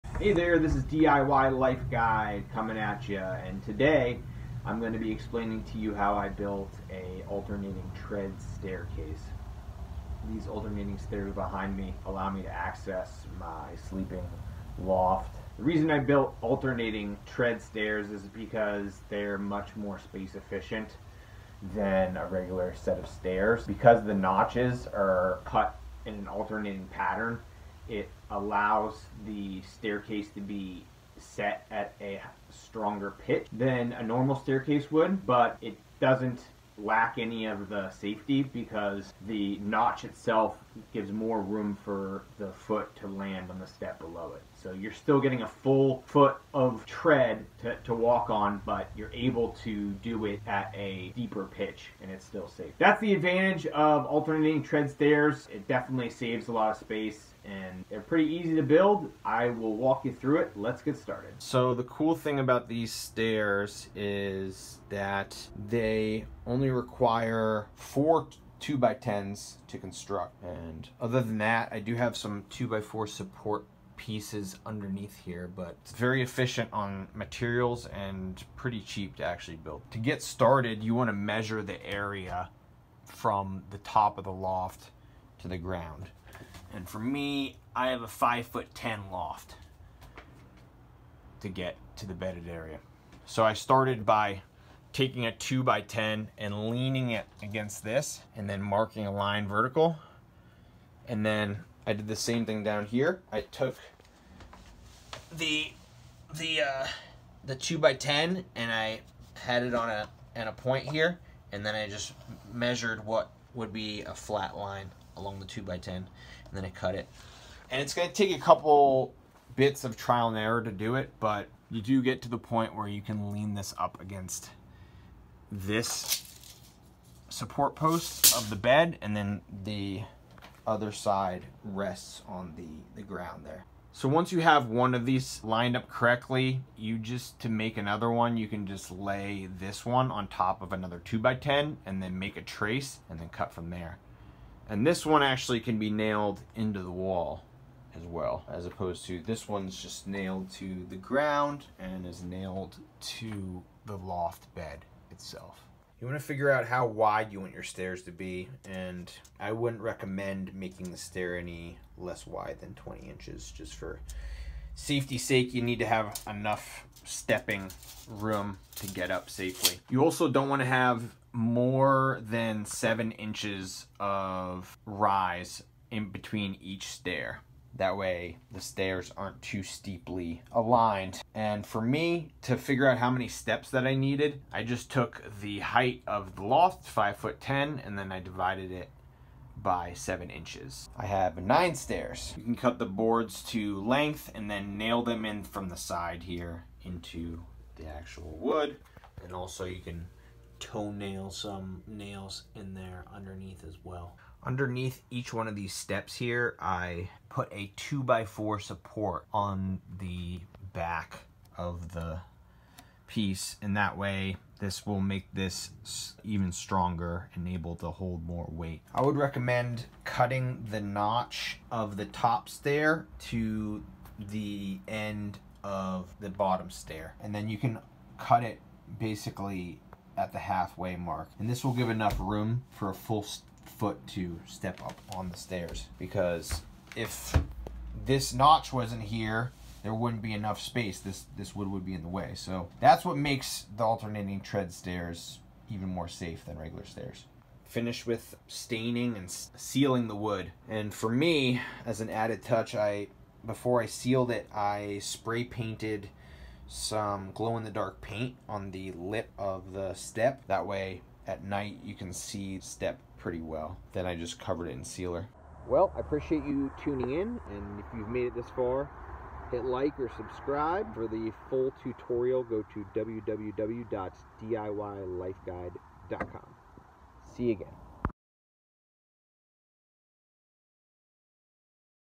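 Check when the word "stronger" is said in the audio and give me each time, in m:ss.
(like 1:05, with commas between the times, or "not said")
0:32, 3:36.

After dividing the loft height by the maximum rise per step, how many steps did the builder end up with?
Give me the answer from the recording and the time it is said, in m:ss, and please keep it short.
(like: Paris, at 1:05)
9, at 3:11.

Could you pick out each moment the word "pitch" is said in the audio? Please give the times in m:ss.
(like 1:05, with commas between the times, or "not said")
0:33, 0:51.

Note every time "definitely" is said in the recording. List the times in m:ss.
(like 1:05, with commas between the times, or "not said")
0:55.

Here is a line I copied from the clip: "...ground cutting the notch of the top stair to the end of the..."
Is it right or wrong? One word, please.
wrong.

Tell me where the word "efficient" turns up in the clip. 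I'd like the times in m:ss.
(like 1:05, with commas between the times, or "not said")
0:20, 1:16.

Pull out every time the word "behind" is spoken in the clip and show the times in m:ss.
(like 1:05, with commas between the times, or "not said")
0:11.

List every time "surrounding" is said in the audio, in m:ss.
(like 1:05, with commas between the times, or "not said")
not said.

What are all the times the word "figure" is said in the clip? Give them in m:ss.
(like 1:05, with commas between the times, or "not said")
2:36, 3:02.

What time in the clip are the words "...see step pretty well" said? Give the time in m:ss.
4:22.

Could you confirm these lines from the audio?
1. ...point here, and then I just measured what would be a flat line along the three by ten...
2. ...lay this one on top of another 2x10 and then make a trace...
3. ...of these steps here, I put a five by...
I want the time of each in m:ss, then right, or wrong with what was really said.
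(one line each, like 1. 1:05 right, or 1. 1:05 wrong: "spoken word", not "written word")
1. 1:50 wrong: "two", not "three"
2. 2:18 right
3. 3:25 wrong: "two", not "five".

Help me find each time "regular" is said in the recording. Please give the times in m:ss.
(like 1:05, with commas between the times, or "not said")
0:22, 4:06.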